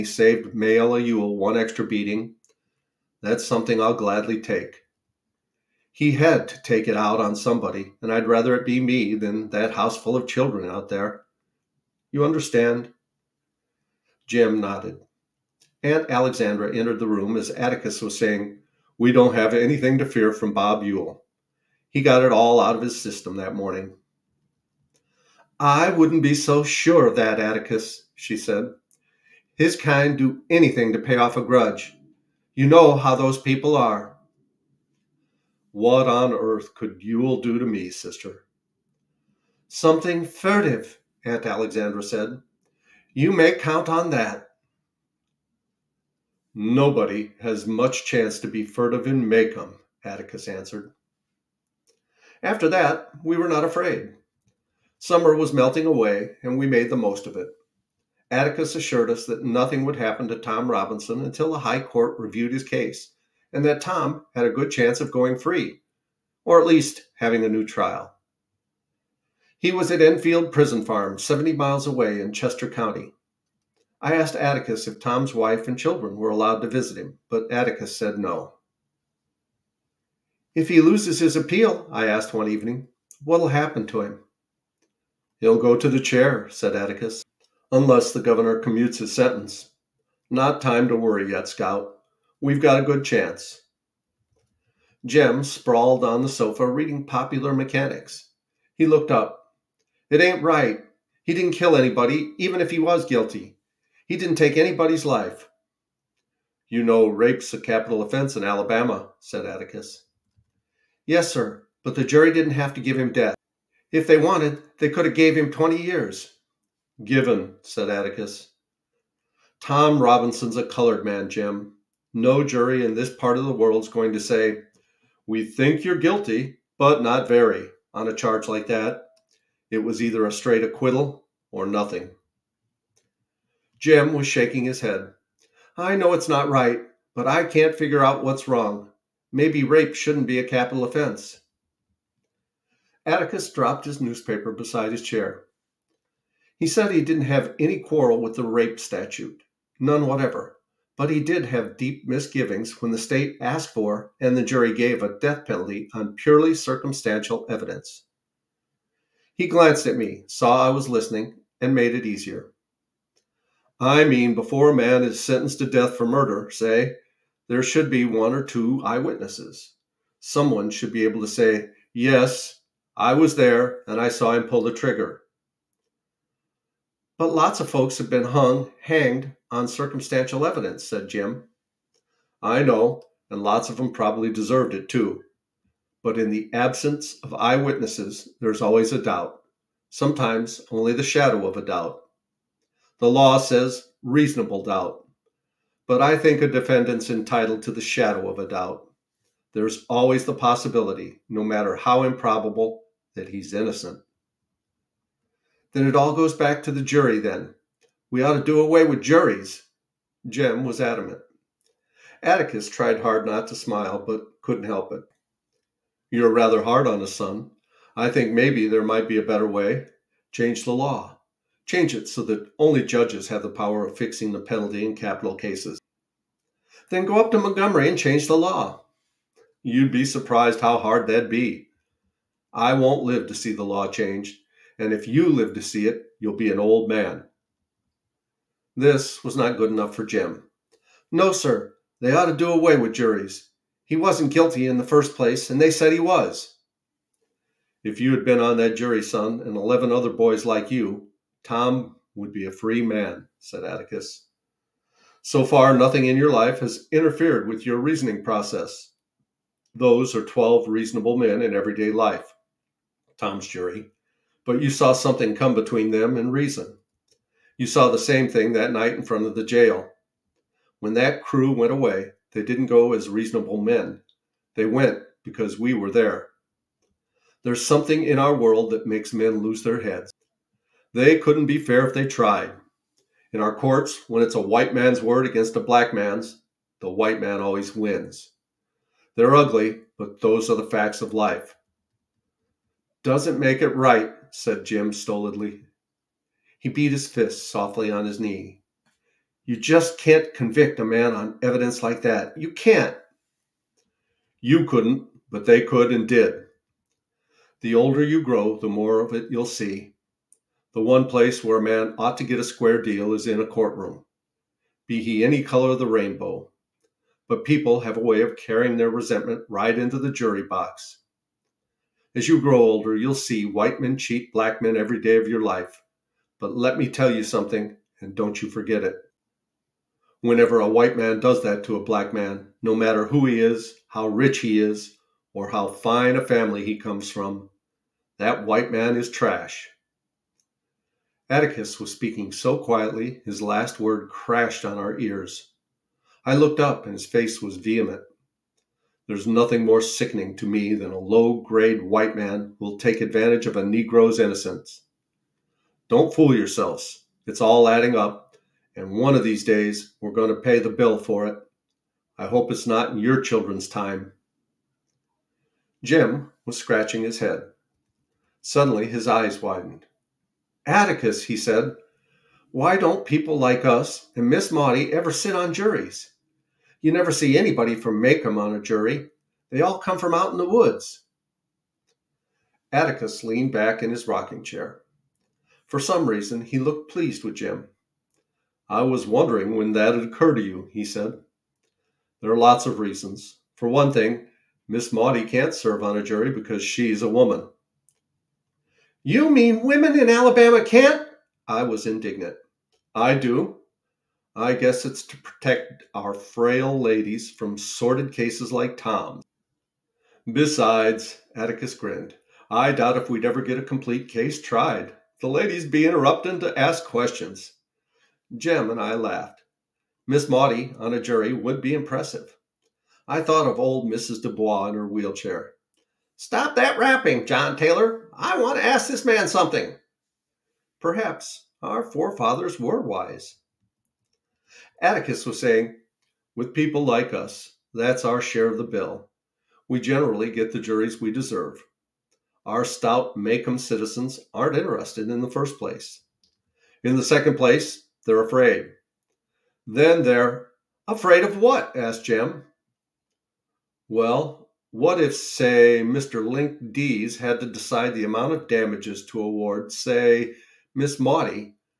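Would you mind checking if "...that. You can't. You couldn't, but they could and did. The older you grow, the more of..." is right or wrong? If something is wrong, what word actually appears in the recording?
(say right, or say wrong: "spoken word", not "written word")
right.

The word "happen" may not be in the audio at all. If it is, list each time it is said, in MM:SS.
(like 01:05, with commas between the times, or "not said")
00:59, 01:23.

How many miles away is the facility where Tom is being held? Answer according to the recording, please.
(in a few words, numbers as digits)
70.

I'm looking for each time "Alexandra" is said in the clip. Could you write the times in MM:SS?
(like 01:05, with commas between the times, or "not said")
00:16, 00:41.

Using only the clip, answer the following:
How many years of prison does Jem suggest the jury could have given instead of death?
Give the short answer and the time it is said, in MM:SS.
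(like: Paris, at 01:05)
20, at 01:55.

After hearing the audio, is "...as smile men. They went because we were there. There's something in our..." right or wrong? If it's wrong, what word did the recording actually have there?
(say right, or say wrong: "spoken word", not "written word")
wrong: "reasonable", not "smile".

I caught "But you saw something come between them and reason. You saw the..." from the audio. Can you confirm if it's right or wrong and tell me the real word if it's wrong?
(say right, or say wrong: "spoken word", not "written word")
right.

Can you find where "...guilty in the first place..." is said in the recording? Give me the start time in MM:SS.
04:04.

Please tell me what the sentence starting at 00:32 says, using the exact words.
You know how those people are.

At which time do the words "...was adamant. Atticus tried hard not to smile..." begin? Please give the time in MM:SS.
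03:30.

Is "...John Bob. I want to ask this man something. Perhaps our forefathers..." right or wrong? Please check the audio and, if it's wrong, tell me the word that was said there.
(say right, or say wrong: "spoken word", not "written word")
wrong: "Taylor", not "Bob".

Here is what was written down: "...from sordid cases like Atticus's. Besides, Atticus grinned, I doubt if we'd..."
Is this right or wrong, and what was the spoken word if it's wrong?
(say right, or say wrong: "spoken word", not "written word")
wrong: "Tom", not "Atticus".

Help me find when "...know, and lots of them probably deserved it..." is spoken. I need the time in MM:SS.
03:02.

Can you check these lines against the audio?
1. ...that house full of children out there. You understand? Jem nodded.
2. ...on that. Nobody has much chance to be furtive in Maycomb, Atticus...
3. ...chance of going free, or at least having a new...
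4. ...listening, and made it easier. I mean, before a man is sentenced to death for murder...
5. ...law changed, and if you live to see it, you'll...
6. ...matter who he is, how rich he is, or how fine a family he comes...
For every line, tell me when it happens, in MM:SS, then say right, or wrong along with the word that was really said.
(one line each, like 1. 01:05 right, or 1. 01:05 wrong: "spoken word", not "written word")
1. 00:09 right
2. 00:43 right
3. 01:04 right
4. 02:40 right
5. 03:53 right
6. 05:32 right.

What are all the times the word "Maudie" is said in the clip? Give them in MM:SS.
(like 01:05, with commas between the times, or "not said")
06:14, 06:34, 07:00, 07:40.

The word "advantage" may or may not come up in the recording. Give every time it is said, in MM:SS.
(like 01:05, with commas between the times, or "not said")
05:52.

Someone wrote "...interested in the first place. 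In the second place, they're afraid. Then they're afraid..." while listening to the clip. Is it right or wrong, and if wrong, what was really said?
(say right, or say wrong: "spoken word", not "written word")
right.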